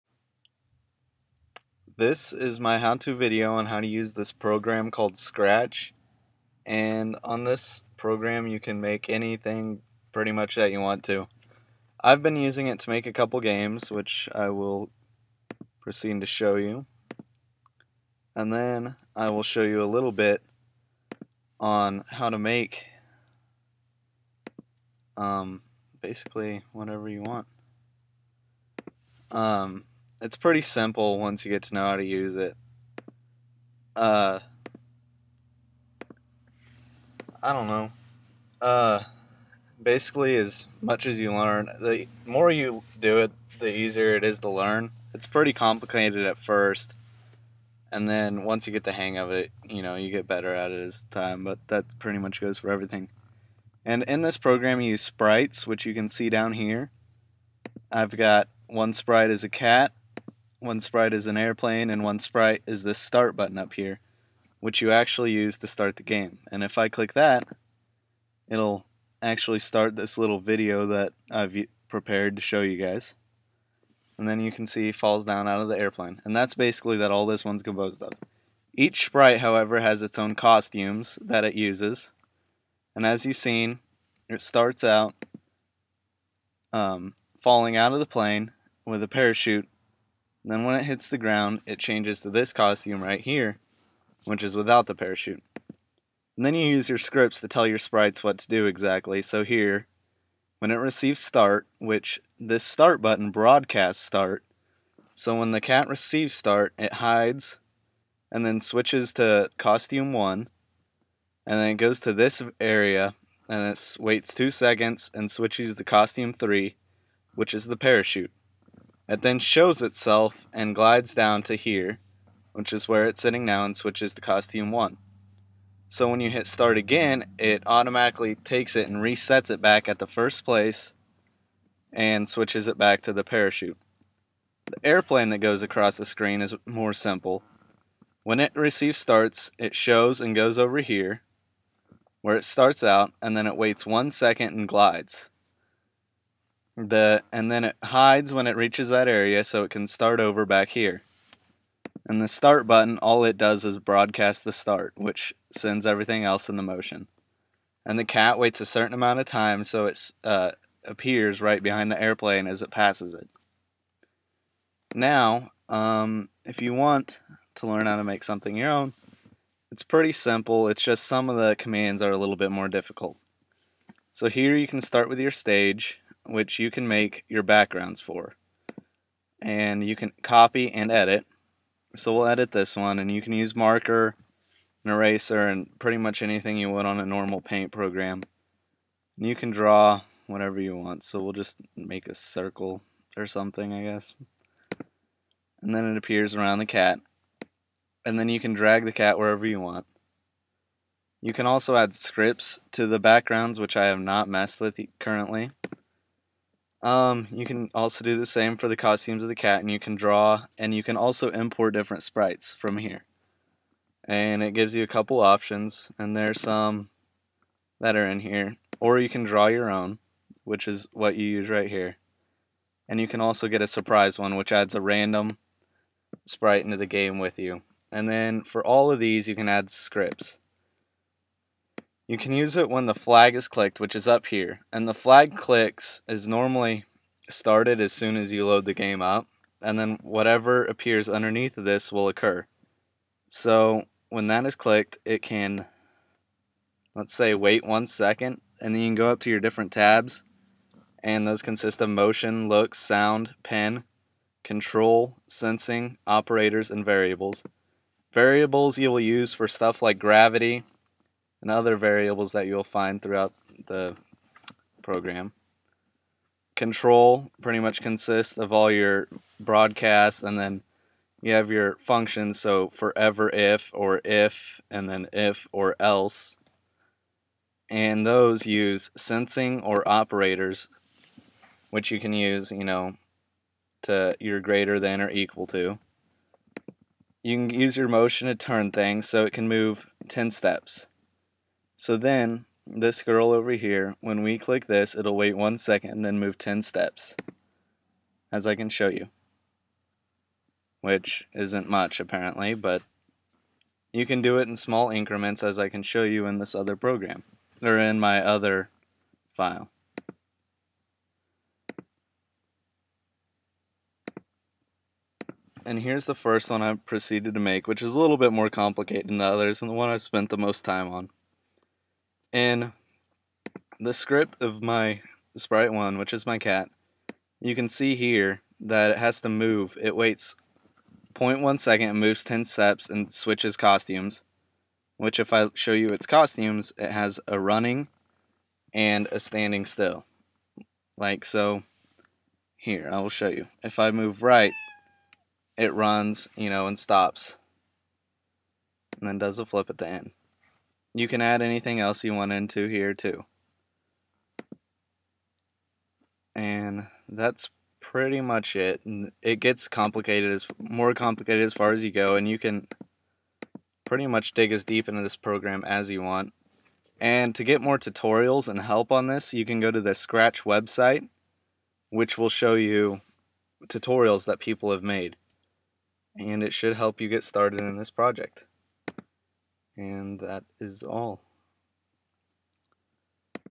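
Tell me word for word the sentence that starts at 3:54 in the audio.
And the flag clicks is normally started as soon as you load the game up.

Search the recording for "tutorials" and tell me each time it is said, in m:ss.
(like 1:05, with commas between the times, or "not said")
6:07, 6:13.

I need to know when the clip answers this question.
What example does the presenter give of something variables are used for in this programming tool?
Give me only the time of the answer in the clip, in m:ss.
4:19.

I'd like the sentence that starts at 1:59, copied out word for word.
It then shows itself and glides down to here, which is where it's sitting now and switches to costume 1.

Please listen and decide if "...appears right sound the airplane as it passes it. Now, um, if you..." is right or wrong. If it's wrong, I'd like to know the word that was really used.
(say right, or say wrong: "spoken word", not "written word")
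wrong: "behind", not "sound".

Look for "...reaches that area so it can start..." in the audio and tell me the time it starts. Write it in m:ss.
2:28.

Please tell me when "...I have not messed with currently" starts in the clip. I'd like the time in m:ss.
3:23.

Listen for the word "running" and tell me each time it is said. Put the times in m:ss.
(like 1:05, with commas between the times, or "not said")
5:37.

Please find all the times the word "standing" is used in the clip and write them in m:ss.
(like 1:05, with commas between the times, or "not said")
5:39.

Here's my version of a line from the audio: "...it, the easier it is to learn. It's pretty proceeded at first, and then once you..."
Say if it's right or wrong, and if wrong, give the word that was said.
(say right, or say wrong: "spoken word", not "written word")
wrong: "complicated", not "proceeded".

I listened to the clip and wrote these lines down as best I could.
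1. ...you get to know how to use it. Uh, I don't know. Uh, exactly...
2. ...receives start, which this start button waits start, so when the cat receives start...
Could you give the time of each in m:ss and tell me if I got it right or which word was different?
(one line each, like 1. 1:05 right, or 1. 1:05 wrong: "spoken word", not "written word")
1. 0:31 wrong: "basically", not "exactly"
2. 1:40 wrong: "broadcasts", not "waits".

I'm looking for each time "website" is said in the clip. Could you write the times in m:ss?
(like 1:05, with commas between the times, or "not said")
6:10.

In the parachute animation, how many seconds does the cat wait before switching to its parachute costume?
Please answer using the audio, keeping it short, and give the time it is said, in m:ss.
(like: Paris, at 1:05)
2, at 1:54.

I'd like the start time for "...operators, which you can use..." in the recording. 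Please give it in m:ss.
4:39.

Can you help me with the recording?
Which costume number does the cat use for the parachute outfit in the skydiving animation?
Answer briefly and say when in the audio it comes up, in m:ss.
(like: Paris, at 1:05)
3, at 1:55.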